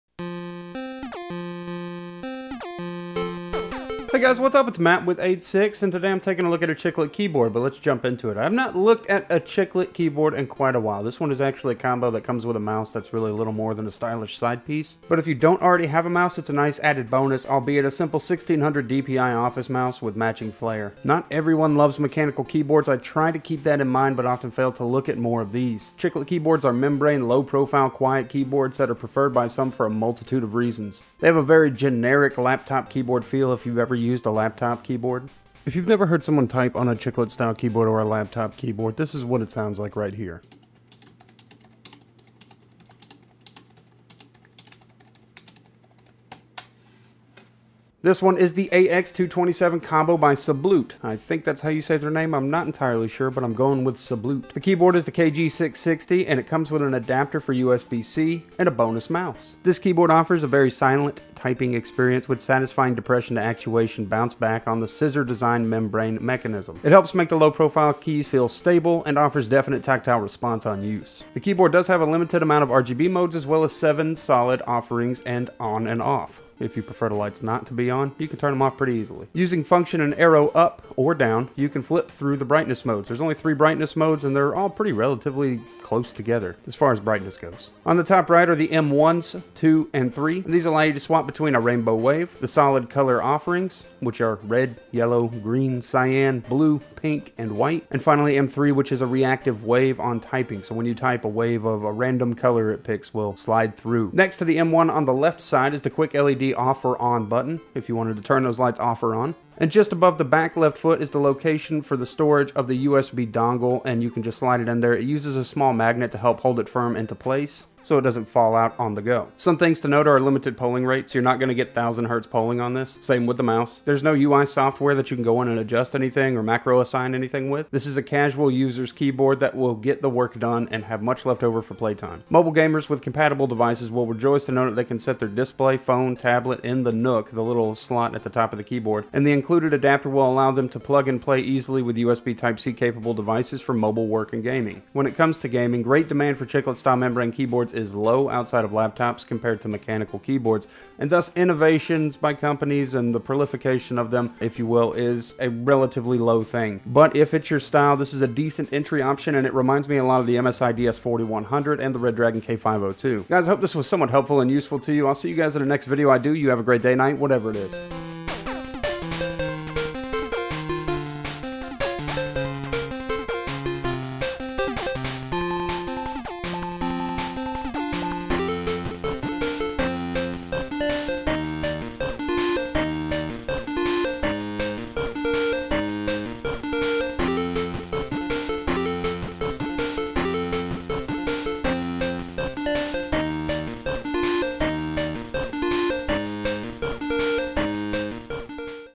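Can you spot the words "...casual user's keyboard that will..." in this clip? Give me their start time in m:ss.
2:08.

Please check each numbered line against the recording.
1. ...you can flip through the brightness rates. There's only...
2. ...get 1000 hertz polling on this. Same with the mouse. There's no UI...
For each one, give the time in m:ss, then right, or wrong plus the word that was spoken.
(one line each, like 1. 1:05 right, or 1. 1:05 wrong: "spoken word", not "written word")
1. 1:21 wrong: "modes", not "rates"
2. 2:01 right.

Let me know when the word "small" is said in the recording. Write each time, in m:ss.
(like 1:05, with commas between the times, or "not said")
1:55.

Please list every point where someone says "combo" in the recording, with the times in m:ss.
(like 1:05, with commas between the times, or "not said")
0:11, 0:49.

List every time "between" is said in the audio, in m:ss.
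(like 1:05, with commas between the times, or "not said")
1:31.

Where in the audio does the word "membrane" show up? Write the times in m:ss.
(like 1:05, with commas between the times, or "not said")
0:26, 1:05, 2:26.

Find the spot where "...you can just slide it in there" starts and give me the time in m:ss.
1:54.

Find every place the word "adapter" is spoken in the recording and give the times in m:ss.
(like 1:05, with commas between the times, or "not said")
0:56, 2:19.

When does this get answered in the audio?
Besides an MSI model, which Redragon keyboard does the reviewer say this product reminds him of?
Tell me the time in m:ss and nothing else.
2:41.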